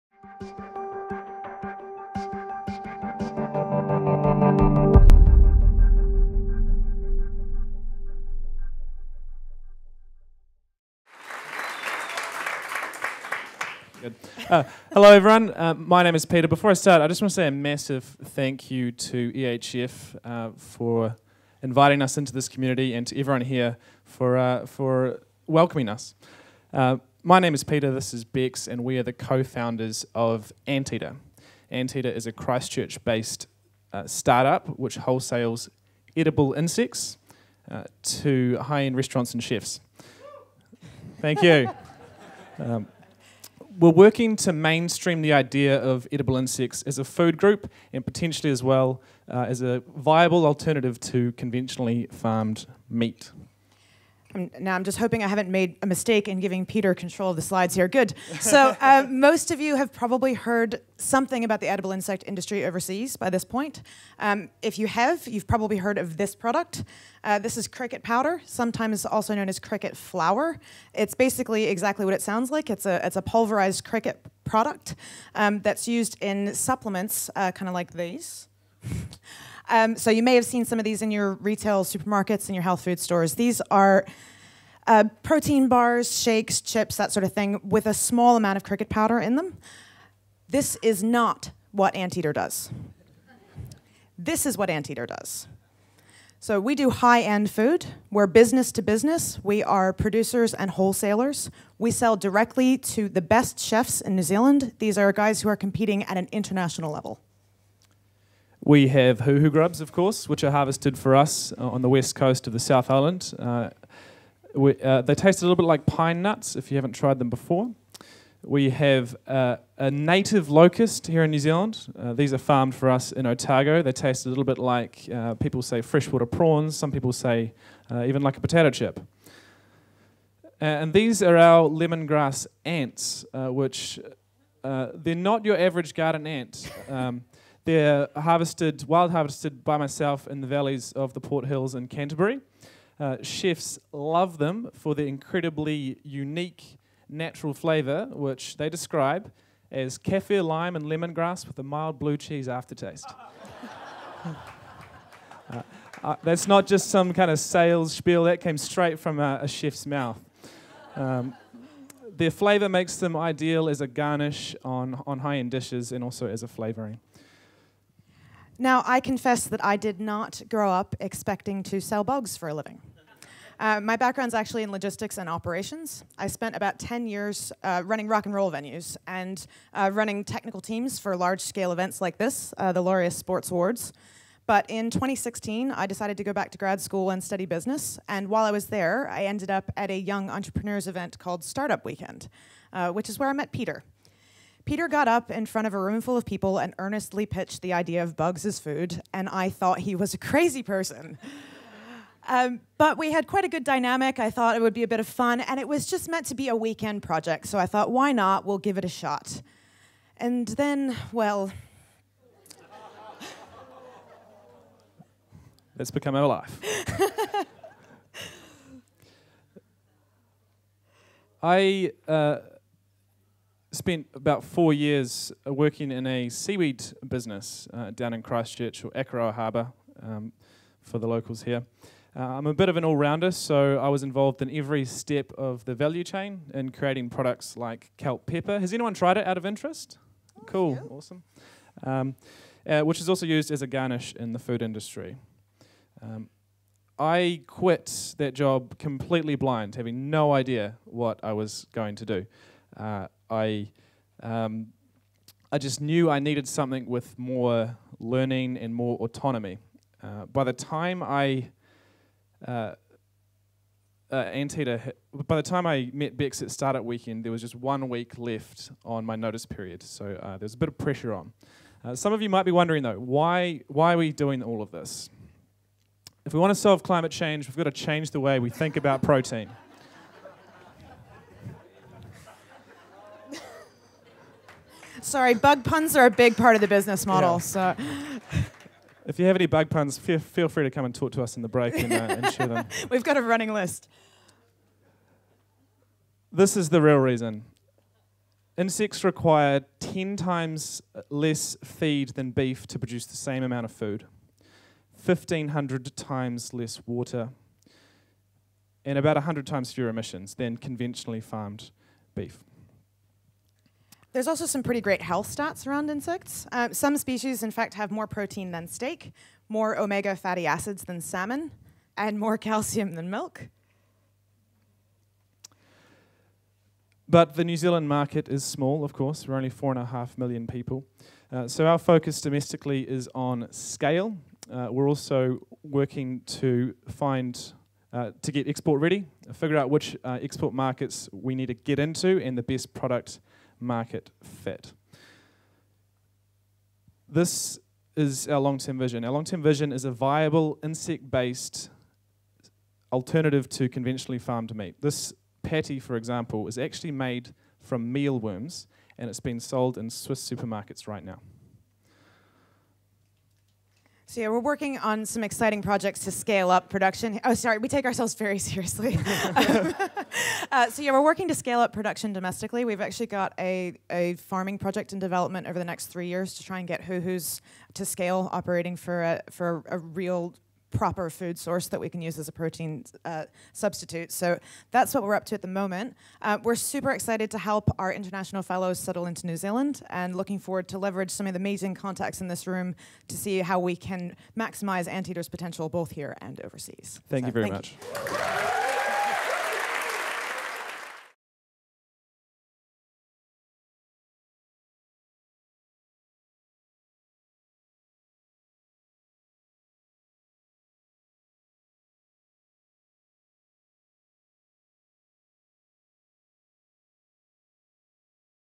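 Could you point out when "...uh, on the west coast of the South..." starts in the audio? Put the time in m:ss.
1:51.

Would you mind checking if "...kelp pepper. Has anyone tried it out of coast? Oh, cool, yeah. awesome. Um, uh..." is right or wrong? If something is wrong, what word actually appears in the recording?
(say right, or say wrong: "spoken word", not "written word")
wrong: "interest", not "coast".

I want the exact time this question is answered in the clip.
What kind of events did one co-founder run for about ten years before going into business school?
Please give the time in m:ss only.
2:58.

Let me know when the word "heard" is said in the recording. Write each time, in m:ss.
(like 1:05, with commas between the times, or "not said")
1:00, 1:05.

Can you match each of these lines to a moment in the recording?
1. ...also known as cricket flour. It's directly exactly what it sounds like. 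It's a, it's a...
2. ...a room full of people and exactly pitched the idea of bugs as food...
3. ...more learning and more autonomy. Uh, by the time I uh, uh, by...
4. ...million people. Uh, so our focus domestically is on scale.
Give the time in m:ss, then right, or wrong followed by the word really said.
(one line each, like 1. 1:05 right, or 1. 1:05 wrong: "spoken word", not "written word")
1. 1:09 wrong: "basically", not "directly"
2. 3:15 wrong: "earnestly", not "exactly"
3. 4:17 right
4. 5:30 right.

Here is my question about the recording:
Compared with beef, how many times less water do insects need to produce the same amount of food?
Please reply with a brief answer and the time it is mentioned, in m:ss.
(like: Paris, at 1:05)
1,500, at 5:05.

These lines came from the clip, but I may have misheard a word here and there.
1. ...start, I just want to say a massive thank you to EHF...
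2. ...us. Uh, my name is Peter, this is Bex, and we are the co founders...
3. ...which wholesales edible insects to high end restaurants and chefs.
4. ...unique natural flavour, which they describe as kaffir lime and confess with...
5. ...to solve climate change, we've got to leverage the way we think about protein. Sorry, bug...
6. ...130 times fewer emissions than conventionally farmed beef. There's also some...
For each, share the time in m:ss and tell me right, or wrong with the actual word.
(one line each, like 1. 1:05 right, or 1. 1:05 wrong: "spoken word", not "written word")
1. 0:16 right
2. 0:25 right
3. 0:34 right
4. 2:26 wrong: "lemongrass", not "confess"
5. 4:36 wrong: "change", not "leverage"
6. 5:09 wrong: "100", not "130".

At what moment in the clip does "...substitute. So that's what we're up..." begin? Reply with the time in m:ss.
6:23.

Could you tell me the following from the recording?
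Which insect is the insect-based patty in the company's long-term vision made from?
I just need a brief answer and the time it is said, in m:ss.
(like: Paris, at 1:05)
mealworms, at 5:57.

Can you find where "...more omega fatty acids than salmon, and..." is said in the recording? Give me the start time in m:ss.
5:19.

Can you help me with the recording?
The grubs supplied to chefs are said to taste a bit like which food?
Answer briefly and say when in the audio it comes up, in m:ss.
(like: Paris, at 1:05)
pine nuts, at 1:55.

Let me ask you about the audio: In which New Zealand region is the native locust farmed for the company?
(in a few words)
Otago.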